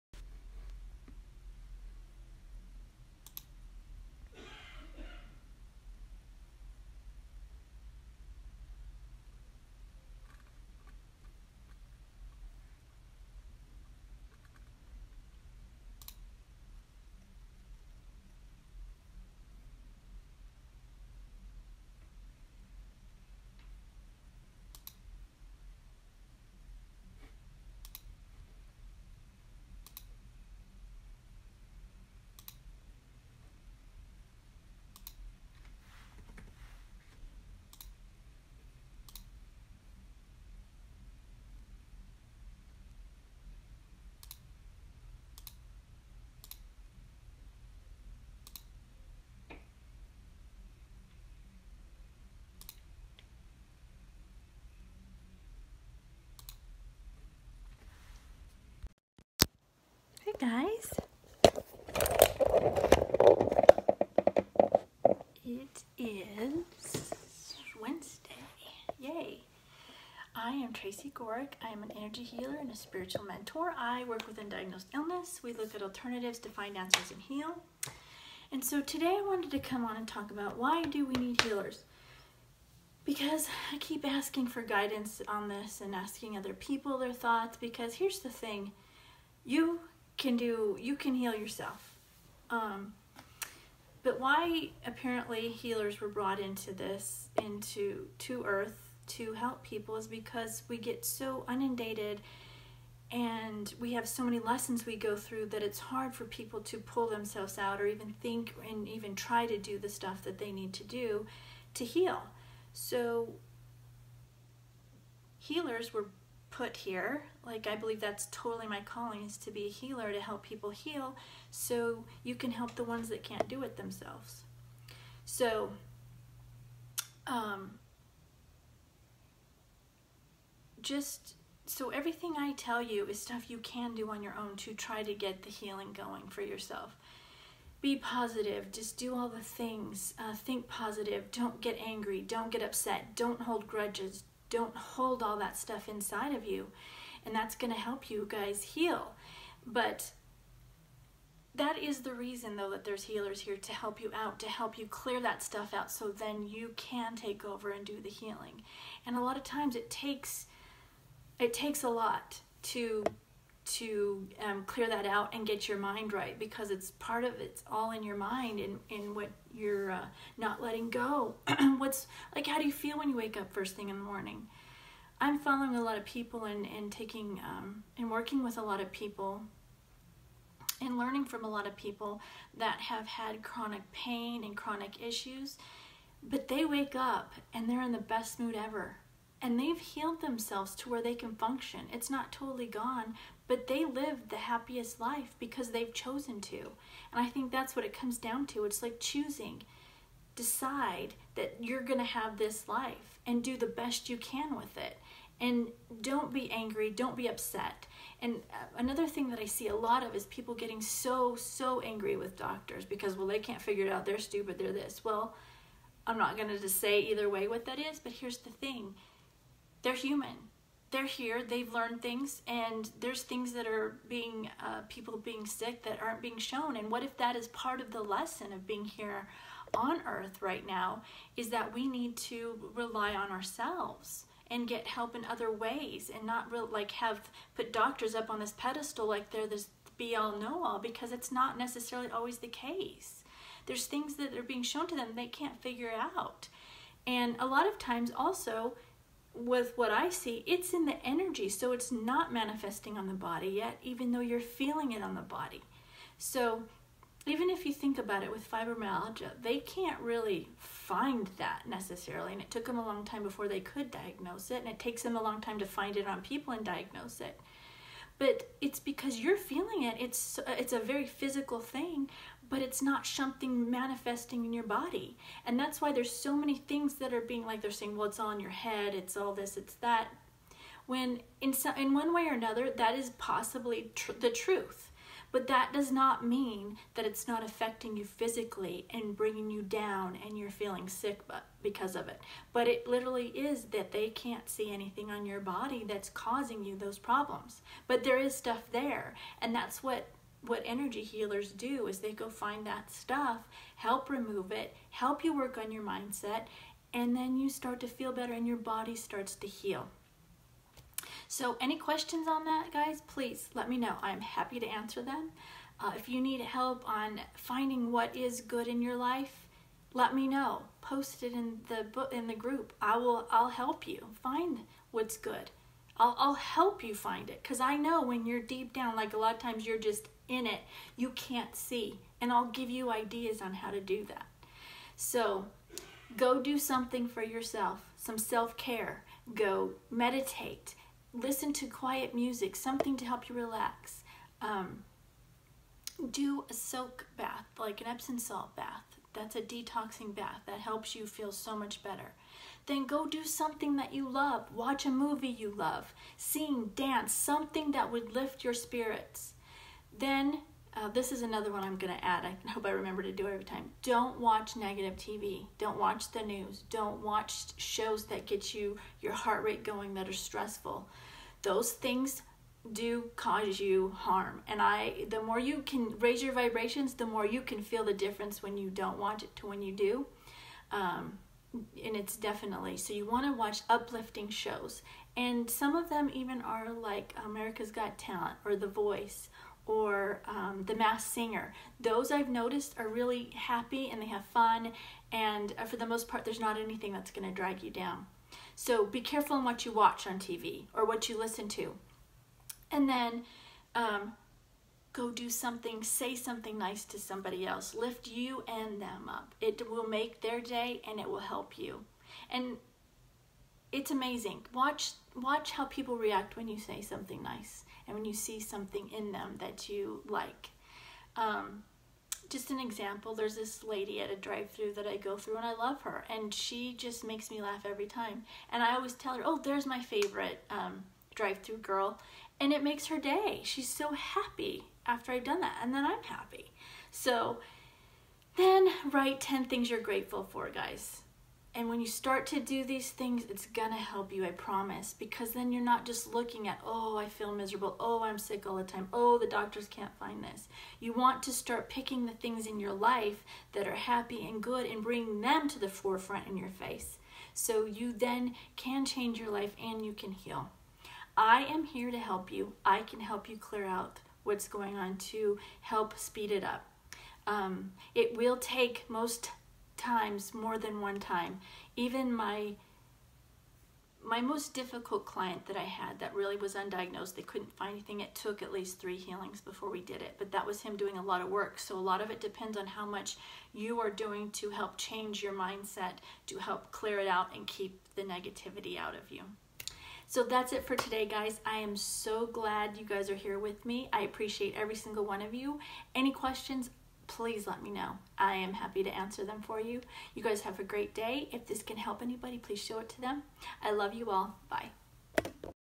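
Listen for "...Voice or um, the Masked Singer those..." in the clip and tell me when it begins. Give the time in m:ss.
6:28.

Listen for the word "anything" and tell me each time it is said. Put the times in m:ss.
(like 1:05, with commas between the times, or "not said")
4:54, 6:36, 7:57.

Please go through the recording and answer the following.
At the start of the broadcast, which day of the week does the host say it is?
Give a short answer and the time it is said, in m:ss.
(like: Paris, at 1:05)
Wednesday, at 1:07.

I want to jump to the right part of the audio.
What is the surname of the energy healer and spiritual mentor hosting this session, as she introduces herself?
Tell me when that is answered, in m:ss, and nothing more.
1:11.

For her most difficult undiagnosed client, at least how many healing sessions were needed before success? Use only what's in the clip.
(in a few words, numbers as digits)
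3.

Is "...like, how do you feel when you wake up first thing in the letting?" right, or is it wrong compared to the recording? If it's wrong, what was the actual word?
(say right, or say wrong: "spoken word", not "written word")
wrong: "morning", not "letting".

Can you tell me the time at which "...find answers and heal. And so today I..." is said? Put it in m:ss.
1:16.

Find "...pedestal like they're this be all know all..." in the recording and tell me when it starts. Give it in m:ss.
3:58.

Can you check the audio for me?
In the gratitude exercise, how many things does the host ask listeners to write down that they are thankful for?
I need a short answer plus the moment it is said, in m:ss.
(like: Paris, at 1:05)
10, at 7:19.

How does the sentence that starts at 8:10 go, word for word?
So that's it for today, guys.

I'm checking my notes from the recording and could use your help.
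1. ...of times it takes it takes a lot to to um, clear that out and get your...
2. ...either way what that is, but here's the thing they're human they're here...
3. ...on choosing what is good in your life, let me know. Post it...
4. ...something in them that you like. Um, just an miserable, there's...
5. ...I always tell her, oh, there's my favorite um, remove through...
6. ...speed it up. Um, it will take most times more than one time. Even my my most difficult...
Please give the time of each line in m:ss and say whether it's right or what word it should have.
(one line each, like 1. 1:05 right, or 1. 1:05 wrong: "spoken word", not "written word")
1. 2:39 right
2. 3:37 right
3. 5:16 wrong: "finding", not "choosing"
4. 6:58 wrong: "example", not "miserable"
5. 7:08 wrong: "drive", not "remove"
6. 7:45 right.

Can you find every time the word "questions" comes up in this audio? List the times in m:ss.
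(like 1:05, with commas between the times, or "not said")
5:11, 8:16.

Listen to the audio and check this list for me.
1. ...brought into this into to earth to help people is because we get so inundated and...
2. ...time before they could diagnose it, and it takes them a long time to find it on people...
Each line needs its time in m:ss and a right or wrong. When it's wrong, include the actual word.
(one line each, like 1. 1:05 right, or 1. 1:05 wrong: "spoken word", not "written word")
1. 1:36 right
2. 4:23 right.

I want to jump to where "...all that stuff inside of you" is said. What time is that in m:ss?
2:25.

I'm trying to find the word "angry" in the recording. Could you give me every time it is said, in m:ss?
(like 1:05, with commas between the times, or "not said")
2:21, 3:26, 3:31.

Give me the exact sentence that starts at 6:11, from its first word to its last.
Those things do cause you harm.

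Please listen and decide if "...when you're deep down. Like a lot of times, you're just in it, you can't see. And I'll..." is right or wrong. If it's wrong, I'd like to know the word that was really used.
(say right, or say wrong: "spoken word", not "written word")
right.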